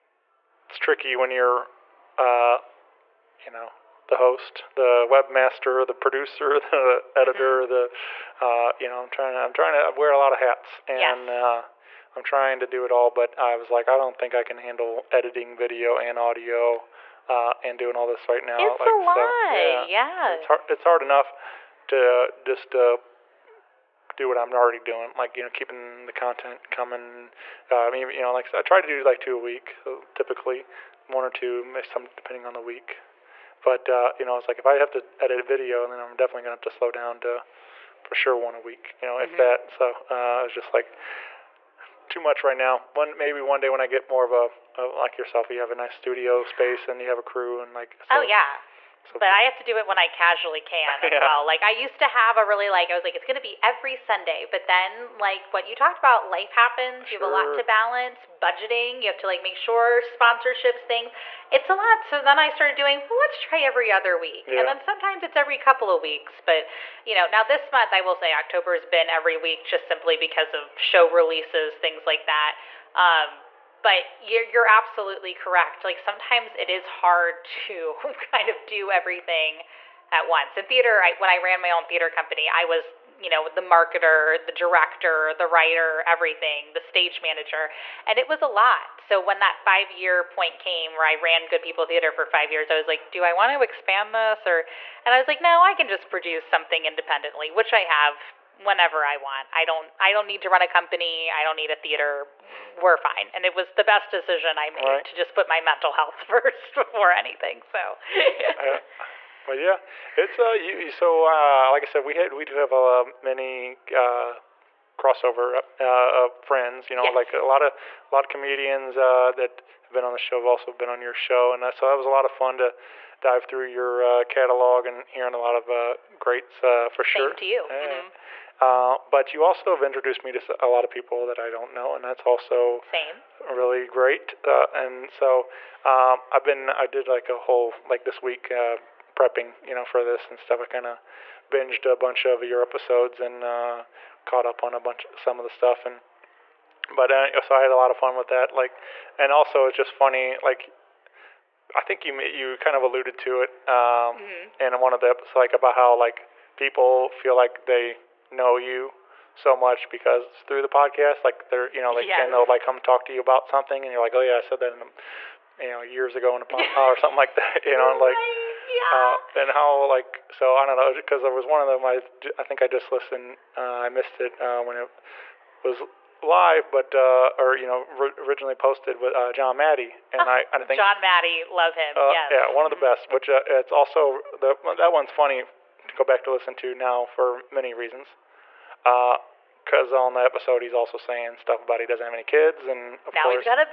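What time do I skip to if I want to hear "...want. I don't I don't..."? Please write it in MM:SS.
01:39.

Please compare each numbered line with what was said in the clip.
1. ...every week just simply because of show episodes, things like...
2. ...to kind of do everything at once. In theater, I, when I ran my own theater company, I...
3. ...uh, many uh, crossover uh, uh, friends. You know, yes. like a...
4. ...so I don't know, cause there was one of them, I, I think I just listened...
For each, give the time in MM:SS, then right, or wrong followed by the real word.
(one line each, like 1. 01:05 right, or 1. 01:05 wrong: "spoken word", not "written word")
1. 01:09 wrong: "releases", not "episodes"
2. 01:17 right
3. 01:52 right
4. 02:50 right.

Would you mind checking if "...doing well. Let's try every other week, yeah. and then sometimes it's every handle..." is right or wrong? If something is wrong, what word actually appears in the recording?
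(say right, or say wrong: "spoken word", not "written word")
wrong: "couple", not "handle".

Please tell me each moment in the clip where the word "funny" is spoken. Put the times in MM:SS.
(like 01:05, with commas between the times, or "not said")
02:29, 03:05.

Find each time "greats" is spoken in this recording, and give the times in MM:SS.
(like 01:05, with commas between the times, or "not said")
02:06, 02:13.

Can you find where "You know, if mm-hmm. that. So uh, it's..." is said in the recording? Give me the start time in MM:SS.
00:39.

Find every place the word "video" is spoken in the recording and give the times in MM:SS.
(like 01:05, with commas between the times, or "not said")
00:15, 00:35.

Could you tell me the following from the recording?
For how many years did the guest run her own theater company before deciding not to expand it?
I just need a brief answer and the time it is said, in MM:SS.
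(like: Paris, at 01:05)
5, at 01:32.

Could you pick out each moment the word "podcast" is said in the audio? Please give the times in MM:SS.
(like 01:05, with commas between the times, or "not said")
02:40, 02:46.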